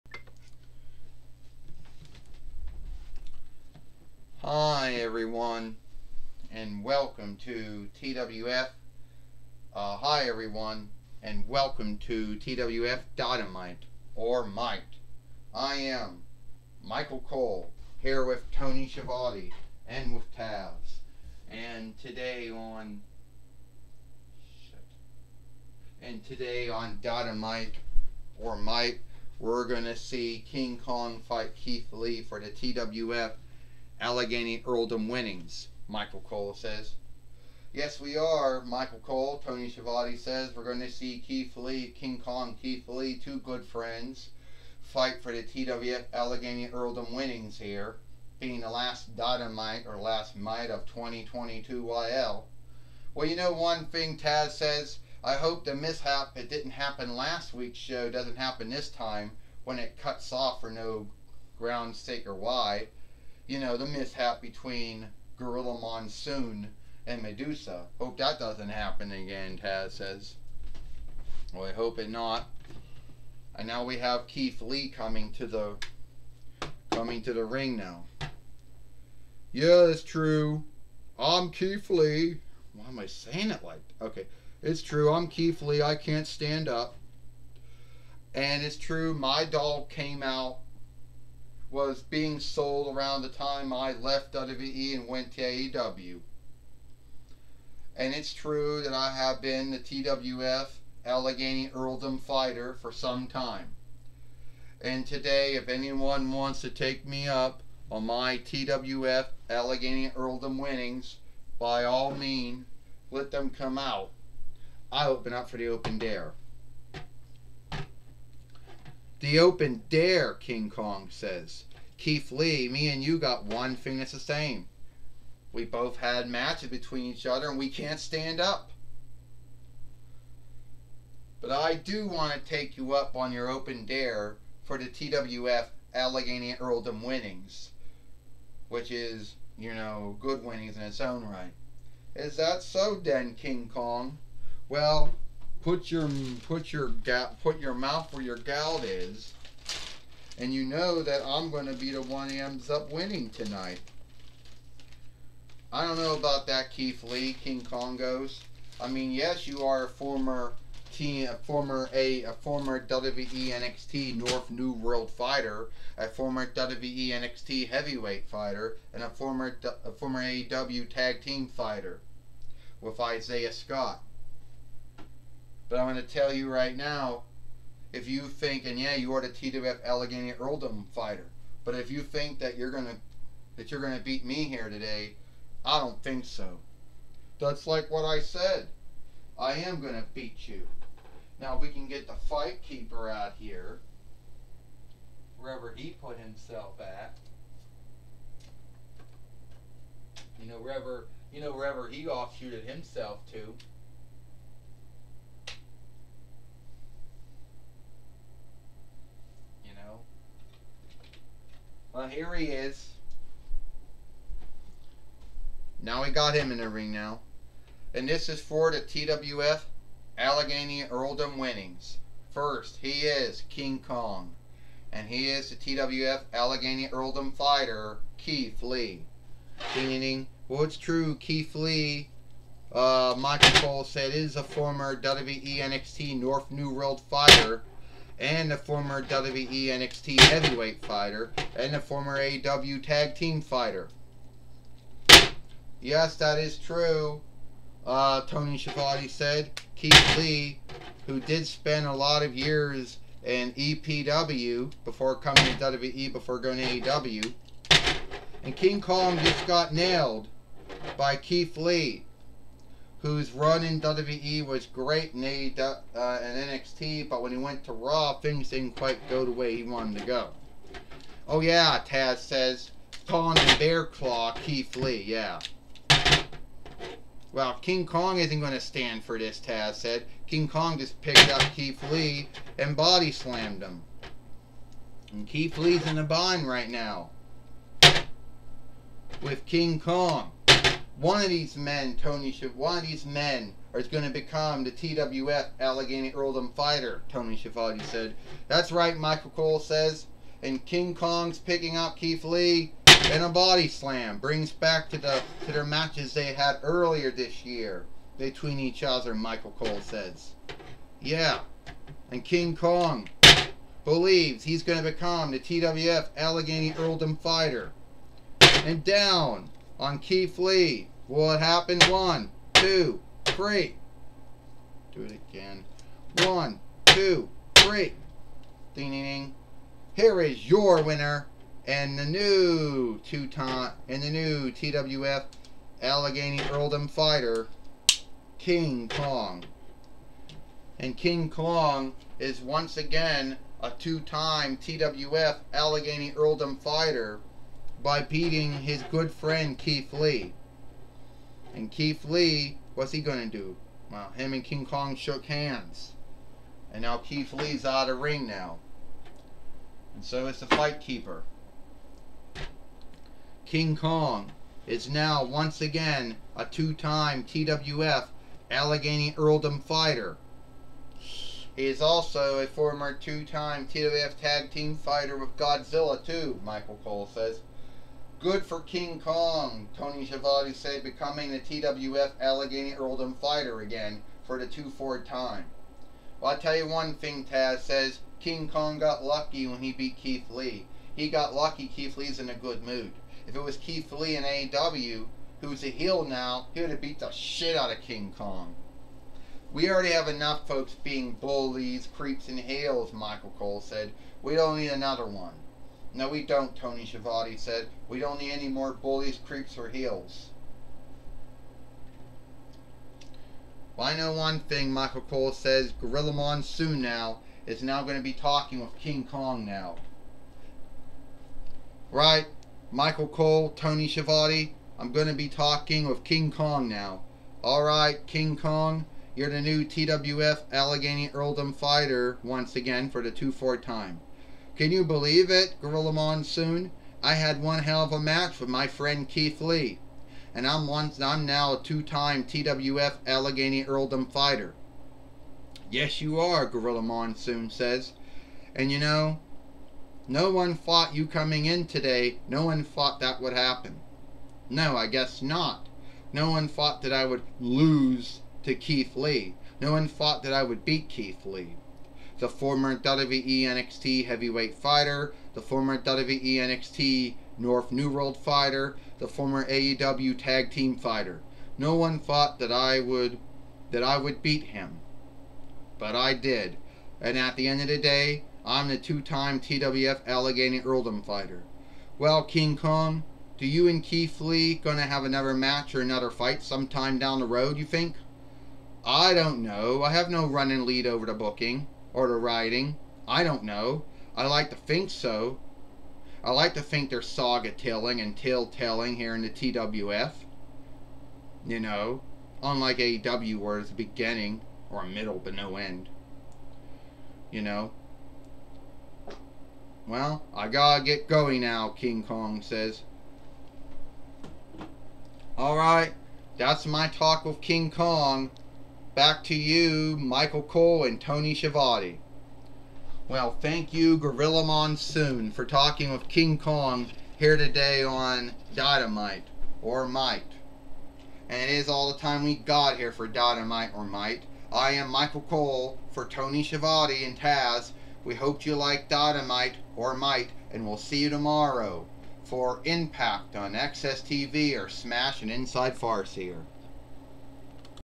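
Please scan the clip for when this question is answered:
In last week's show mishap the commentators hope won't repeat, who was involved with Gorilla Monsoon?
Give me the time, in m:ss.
1:07.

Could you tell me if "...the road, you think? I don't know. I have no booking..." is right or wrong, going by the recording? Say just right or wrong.
wrong.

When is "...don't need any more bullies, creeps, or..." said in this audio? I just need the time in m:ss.
6:47.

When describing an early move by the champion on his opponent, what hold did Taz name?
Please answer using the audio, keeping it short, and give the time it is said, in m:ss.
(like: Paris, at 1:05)
Bear Claw, at 4:33.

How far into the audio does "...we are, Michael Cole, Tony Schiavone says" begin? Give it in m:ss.
0:37.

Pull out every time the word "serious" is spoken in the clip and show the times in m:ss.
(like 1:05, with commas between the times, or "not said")
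not said.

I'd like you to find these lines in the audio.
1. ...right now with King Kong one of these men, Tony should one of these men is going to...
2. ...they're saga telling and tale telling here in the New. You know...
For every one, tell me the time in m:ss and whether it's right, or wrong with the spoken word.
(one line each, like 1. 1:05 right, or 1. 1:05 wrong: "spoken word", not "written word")
1. 4:46 right
2. 8:16 wrong: "TWF", not "New".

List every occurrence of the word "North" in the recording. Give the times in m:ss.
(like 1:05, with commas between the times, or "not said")
2:44, 3:56, 7:47.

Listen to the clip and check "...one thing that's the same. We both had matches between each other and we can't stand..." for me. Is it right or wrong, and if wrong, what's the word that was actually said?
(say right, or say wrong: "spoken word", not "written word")
right.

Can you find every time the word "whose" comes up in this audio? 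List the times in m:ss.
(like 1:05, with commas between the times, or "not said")
4:23.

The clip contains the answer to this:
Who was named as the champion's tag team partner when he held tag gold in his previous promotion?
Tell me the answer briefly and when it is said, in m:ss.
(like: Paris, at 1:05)
Isaiah Scott, at 2:52.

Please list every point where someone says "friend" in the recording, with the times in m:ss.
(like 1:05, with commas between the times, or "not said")
0:43, 5:49, 7:18.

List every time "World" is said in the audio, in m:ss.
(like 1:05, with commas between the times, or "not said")
2:44, 3:56, 7:47.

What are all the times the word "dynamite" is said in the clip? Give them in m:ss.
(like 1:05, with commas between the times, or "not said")
0:13, 0:27, 0:49, 8:48, 8:53, 8:58.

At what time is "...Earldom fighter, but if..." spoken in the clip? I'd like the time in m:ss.
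3:00.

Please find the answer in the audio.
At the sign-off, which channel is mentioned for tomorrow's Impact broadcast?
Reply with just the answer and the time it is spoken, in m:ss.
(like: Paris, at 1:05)
XSTV, at 9:03.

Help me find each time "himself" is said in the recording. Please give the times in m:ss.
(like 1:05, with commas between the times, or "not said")
3:16, 3:22.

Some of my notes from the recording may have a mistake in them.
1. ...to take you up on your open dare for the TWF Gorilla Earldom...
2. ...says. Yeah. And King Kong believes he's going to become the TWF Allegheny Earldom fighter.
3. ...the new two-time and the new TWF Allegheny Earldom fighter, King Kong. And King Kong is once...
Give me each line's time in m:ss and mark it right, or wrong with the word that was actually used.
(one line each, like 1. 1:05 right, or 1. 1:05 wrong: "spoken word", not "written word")
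1. 2:12 wrong: "Allegheny", not "Gorilla"
2. 5:09 right
3. 5:31 right.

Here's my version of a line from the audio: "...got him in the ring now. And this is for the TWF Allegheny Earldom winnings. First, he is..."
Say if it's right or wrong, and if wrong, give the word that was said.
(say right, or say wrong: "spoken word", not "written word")
right.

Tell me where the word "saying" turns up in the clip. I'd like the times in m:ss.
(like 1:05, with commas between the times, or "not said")
1:23.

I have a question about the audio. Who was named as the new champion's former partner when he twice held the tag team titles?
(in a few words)
Godzilla.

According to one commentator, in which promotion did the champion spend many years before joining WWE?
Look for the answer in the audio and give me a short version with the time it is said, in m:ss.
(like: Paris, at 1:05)
EPW, at 4:13.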